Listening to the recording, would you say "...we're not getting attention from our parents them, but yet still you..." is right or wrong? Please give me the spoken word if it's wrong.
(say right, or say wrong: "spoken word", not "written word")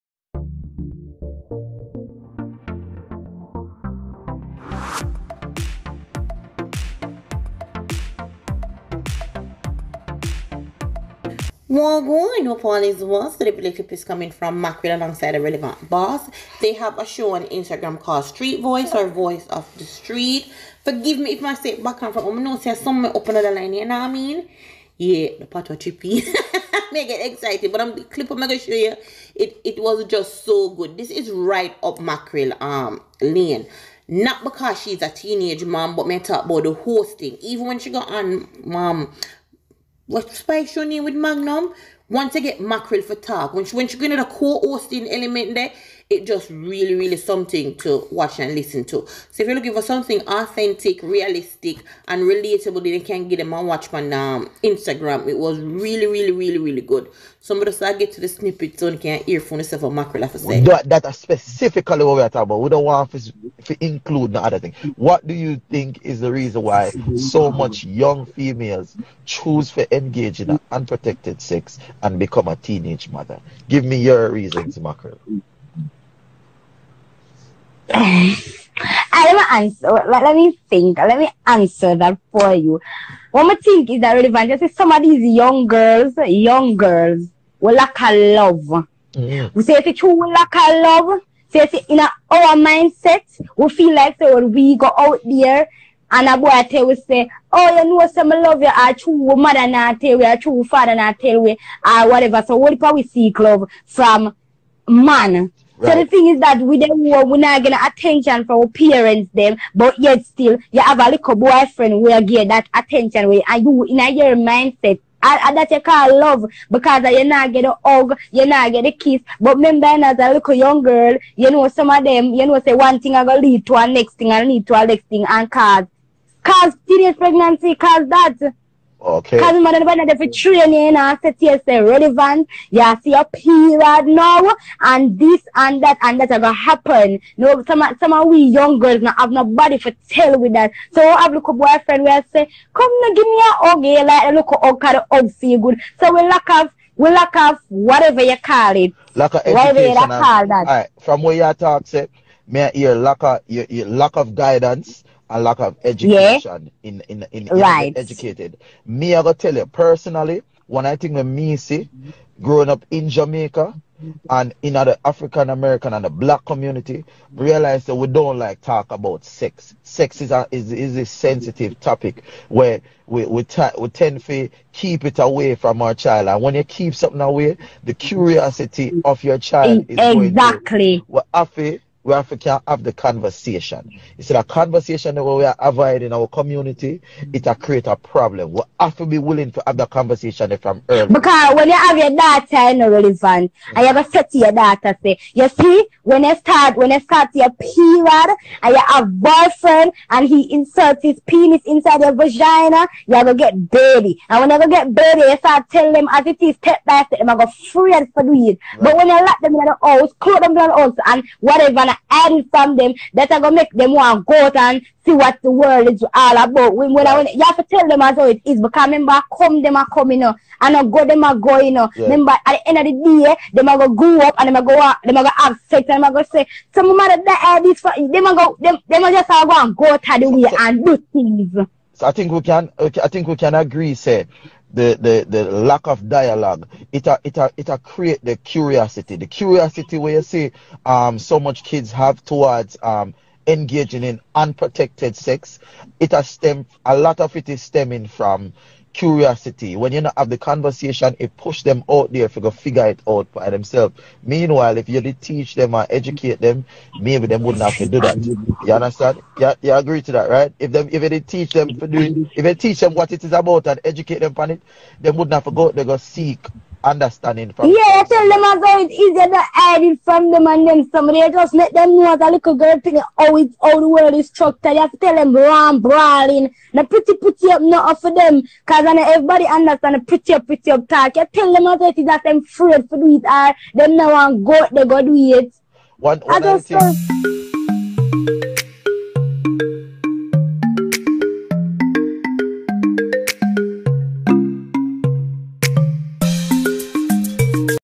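right.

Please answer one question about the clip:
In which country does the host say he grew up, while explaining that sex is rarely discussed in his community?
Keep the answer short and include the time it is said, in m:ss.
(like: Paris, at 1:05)
Jamaica, at 2:43.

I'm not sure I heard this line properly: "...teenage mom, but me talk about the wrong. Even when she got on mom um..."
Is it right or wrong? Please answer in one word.
wrong.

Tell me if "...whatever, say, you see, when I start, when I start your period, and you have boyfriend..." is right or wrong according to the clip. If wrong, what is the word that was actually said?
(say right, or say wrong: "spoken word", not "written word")
wrong: "daughter", not "whatever".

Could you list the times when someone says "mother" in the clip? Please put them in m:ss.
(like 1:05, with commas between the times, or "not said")
1:13, 1:39, 2:09, 3:46.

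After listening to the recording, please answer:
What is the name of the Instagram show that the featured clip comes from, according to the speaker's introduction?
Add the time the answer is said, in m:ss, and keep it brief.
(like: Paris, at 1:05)
Street Voice, at 0:18.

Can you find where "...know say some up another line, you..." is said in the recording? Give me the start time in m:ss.
0:22.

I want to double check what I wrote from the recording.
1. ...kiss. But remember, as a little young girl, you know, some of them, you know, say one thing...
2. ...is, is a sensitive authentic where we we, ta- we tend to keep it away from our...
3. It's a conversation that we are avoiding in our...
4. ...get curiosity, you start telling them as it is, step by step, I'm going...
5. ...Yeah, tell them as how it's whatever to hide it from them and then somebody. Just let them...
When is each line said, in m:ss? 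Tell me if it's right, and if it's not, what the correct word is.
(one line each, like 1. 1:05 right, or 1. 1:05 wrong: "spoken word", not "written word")
1. 1:58 right
2. 2:50 wrong: "topic", not "authentic"
3. 3:04 right
4. 3:24 wrong: "dirty", not "curiosity"
5. 4:27 wrong: "easier", not "whatever".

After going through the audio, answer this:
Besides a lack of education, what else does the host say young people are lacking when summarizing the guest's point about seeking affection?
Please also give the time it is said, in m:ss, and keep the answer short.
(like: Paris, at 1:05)
Guidance, at 2:34.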